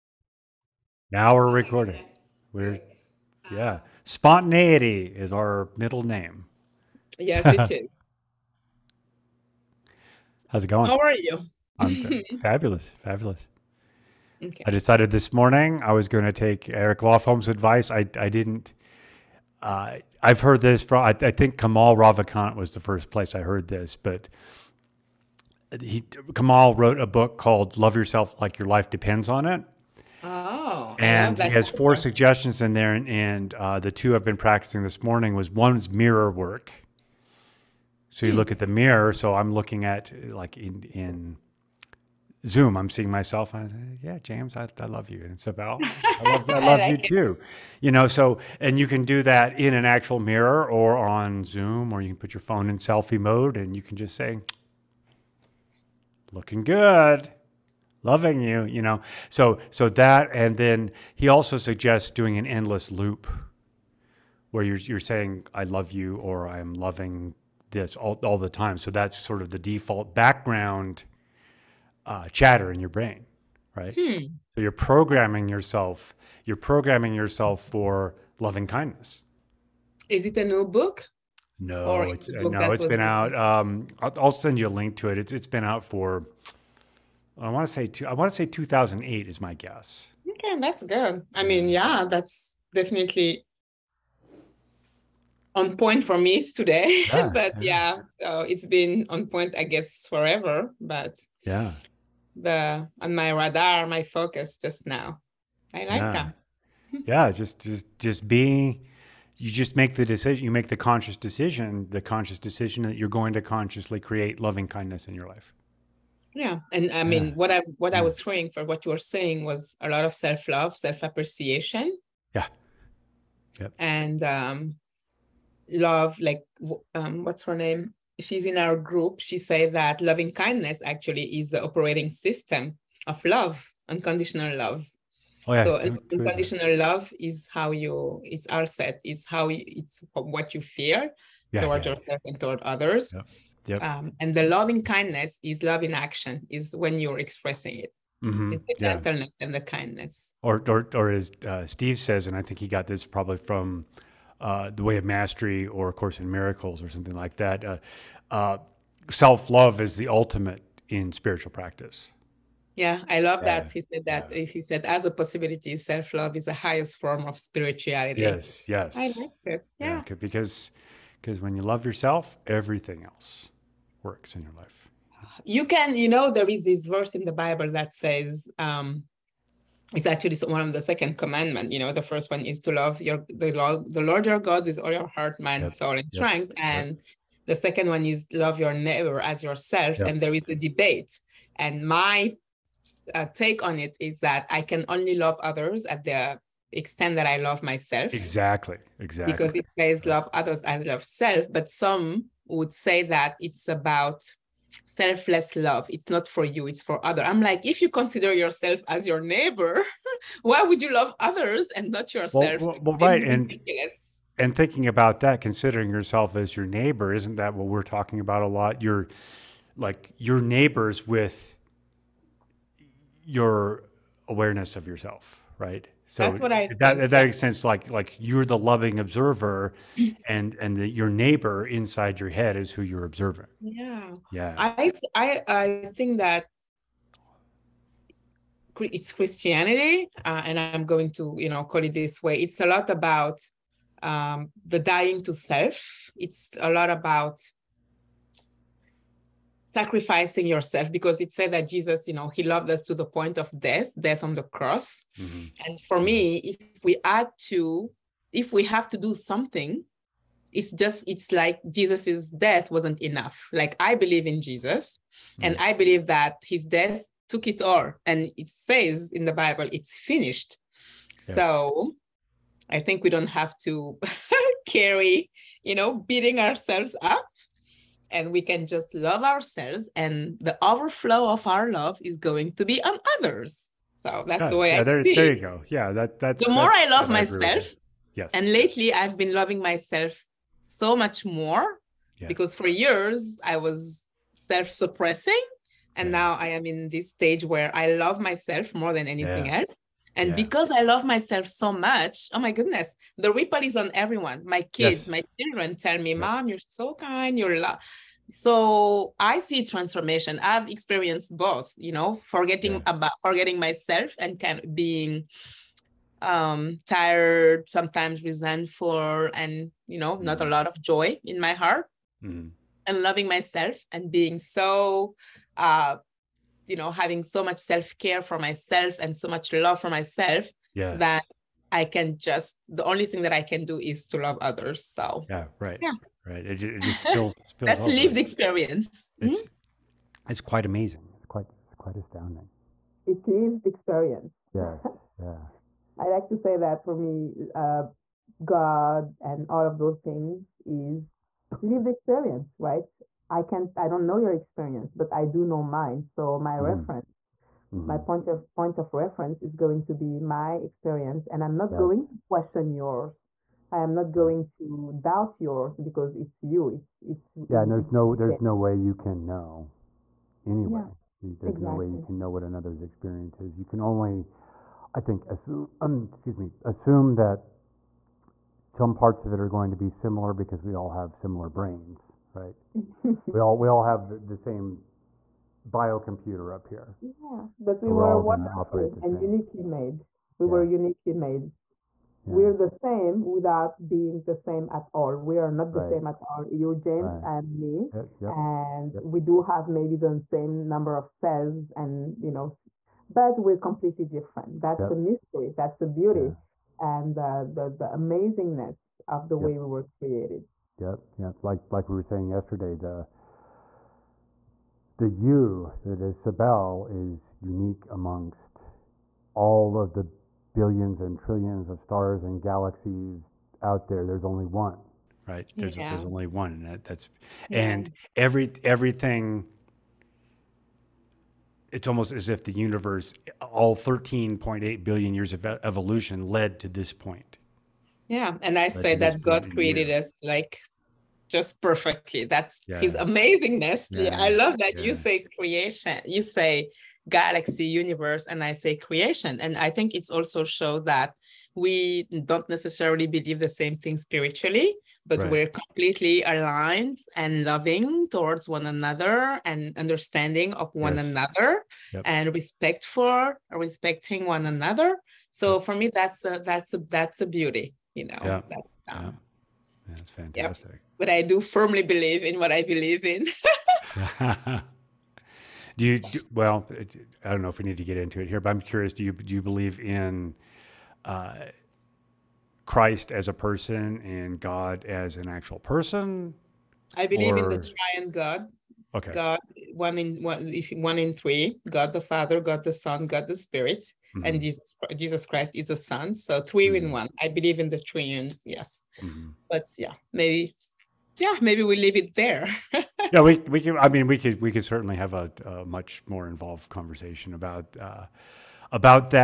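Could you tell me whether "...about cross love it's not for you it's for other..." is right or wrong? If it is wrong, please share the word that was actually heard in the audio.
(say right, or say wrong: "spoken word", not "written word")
wrong: "selfless", not "cross".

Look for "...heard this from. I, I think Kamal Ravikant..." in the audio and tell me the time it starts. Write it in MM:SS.
00:20.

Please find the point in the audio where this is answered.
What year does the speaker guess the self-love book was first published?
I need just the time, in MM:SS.
01:28.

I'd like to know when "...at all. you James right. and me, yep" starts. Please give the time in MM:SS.
06:36.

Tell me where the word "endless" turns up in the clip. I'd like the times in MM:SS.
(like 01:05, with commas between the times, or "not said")
01:02.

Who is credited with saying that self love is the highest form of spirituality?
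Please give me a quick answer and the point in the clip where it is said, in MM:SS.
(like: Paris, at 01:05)
Steve, at 02:31.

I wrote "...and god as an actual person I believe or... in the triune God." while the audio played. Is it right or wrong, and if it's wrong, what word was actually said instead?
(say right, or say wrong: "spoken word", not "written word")
right.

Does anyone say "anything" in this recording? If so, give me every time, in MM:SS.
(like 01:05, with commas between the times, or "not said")
04:59.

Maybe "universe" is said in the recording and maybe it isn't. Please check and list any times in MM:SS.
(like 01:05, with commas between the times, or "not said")
07:12, 07:27.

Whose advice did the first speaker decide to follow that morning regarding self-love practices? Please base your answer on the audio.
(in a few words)
Eric Lofholm.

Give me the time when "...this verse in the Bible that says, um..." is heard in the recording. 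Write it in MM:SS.
02:56.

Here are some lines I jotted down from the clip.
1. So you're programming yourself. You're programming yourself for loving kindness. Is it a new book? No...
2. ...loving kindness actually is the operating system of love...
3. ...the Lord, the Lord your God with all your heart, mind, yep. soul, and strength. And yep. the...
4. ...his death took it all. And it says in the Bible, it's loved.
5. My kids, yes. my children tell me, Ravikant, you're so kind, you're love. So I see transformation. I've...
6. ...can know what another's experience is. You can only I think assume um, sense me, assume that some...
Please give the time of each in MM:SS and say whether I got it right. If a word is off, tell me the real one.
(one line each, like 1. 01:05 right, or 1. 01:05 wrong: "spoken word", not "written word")
1. 01:14 right
2. 02:09 right
3. 03:03 right
4. 04:26 wrong: "finished", not "loved"
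5. 05:04 wrong: "Mom", not "Ravikant"
6. 06:12 wrong: "excuse", not "sense".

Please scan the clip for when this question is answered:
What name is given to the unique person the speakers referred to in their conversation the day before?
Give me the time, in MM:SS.
06:56.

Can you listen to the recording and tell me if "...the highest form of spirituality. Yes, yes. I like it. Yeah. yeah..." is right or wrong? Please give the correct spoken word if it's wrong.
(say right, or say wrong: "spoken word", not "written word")
right.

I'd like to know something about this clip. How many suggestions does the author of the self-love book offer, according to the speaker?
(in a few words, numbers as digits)
4.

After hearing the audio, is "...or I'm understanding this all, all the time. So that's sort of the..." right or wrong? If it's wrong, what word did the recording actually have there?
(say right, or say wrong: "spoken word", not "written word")
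wrong: "loving", not "understanding".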